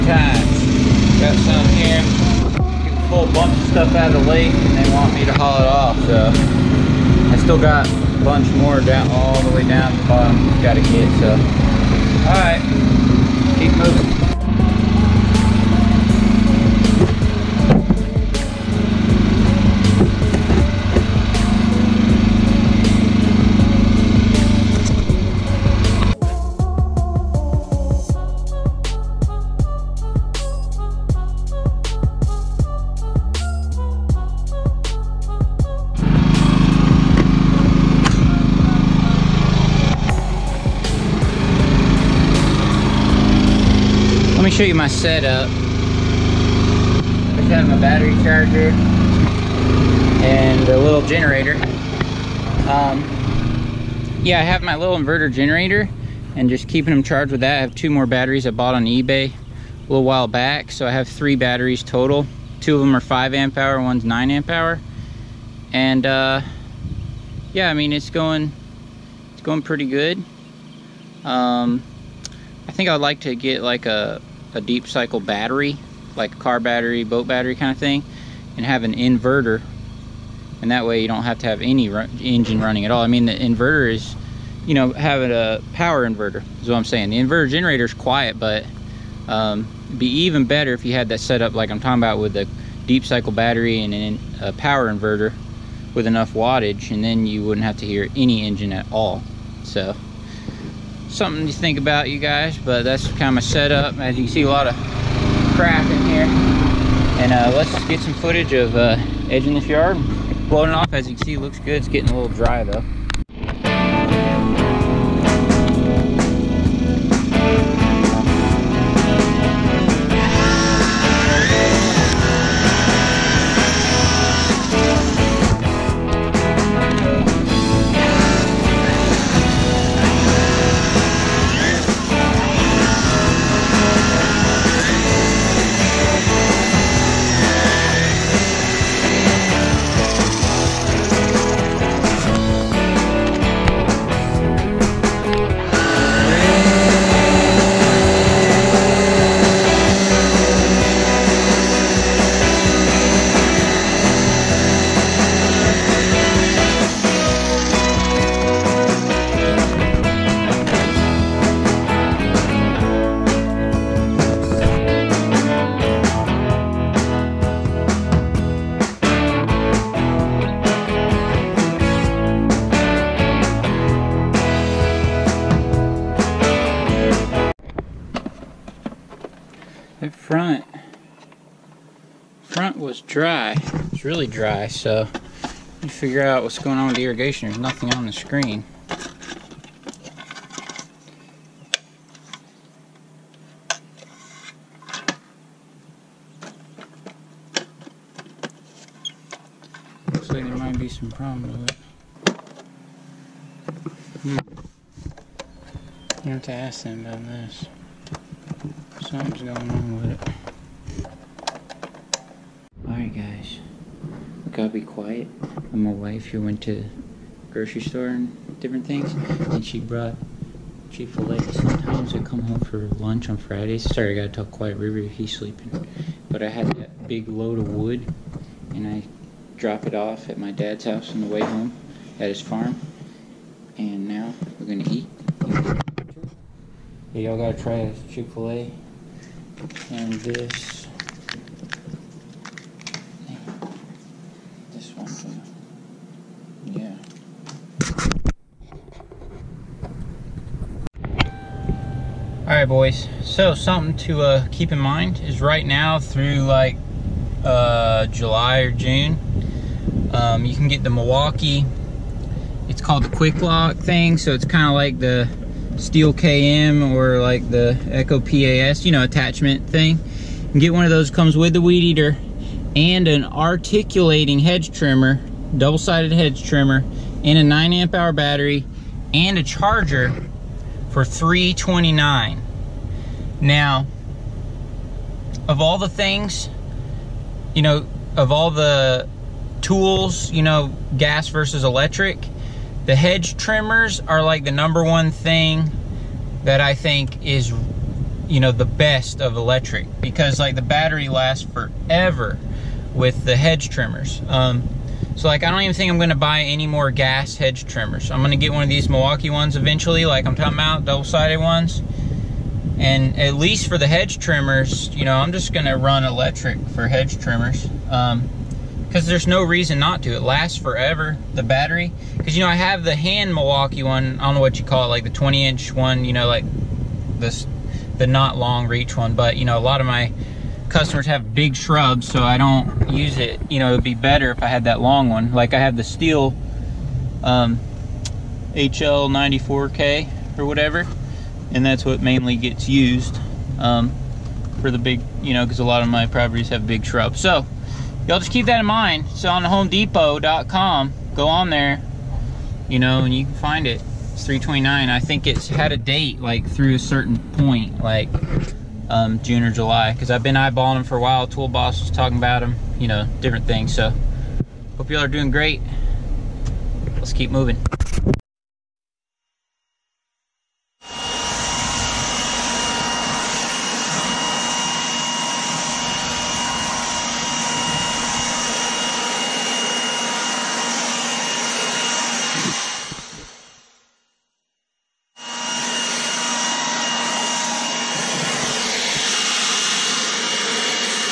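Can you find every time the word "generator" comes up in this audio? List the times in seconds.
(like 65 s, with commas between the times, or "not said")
51 s, 55 s, 87 s.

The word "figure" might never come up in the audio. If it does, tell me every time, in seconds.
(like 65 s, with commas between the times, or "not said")
185 s.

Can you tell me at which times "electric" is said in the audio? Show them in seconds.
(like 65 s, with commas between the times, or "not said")
291 s, 299 s, 316 s.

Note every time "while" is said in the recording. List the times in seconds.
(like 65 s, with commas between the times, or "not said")
60 s, 361 s.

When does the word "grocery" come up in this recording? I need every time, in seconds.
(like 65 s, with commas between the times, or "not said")
217 s.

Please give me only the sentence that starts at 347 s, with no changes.
So, y'all just keep that in mind.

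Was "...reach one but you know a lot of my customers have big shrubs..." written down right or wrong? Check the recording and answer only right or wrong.
right.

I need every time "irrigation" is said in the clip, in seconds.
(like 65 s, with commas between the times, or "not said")
187 s.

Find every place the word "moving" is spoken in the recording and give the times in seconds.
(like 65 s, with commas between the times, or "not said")
13 s, 367 s.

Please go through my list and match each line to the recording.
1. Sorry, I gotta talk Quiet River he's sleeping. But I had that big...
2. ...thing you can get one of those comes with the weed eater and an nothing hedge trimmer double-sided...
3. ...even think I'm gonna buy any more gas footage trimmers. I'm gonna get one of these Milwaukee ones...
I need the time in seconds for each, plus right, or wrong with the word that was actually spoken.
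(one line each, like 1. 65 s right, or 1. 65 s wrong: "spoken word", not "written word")
1. 223 s right
2. 269 s wrong: "articulating", not "nothing"
3. 305 s wrong: "hedge", not "footage".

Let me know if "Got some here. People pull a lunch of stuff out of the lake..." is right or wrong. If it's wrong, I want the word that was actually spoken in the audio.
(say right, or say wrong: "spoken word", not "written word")
wrong: "bunch", not "lunch".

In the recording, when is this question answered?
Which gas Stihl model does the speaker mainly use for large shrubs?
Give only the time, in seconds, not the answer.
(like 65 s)
338 s.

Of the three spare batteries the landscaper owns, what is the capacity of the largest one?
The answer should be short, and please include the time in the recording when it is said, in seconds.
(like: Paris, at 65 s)
9 amp hour, at 64 s.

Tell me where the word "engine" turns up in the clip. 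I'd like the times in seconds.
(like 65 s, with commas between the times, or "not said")
82 s, 98 s.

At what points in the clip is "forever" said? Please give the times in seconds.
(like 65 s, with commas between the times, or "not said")
301 s, 320 s.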